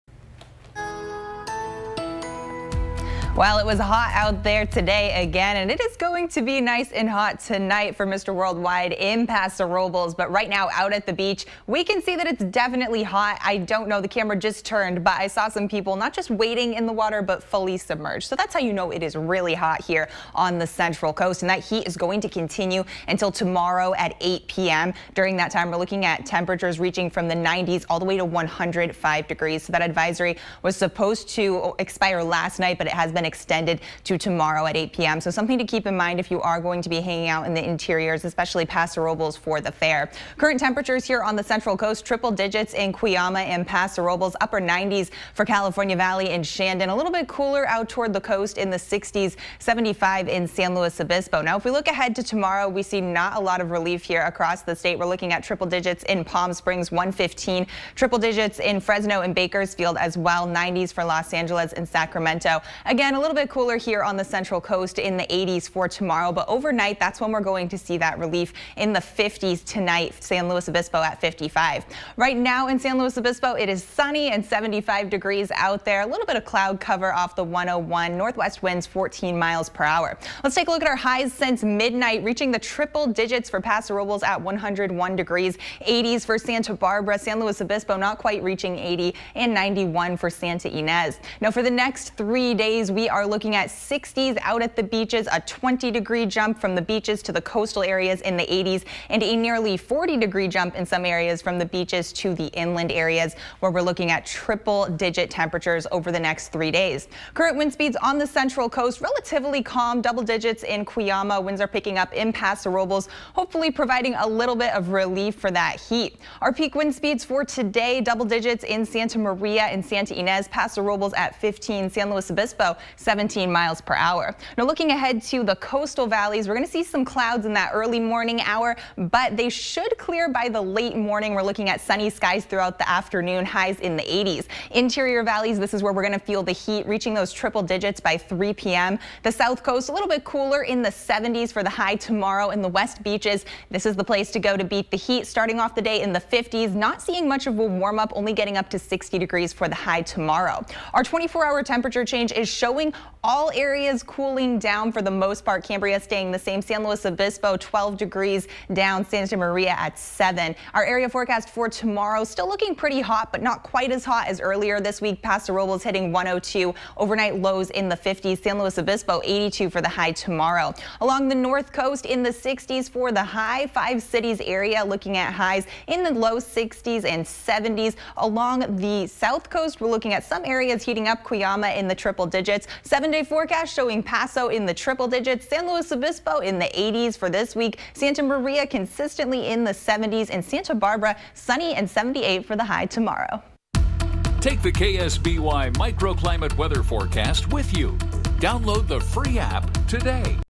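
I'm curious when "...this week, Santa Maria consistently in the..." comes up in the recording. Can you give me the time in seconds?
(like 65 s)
187 s.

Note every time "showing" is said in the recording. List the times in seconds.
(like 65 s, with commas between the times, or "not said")
152 s, 183 s.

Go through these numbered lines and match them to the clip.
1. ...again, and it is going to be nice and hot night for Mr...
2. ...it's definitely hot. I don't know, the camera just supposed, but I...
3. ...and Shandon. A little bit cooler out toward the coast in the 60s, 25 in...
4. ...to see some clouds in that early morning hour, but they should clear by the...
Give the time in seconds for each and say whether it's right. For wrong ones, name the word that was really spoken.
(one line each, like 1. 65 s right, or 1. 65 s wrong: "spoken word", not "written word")
1. 5 s wrong: "tonight", not "night"
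2. 12 s wrong: "turned", not "supposed"
3. 46 s wrong: "75", not "25"
4. 126 s right.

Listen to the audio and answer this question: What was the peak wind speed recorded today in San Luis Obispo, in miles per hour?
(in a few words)
17.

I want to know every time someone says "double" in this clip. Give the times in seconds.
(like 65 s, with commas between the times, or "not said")
110 s, 118 s.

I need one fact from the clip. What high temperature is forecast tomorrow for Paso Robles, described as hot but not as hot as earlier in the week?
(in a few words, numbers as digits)
102.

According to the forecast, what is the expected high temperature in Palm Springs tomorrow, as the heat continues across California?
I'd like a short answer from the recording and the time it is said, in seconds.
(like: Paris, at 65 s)
115, at 56 s.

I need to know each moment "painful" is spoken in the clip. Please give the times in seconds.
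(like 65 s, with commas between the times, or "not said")
not said.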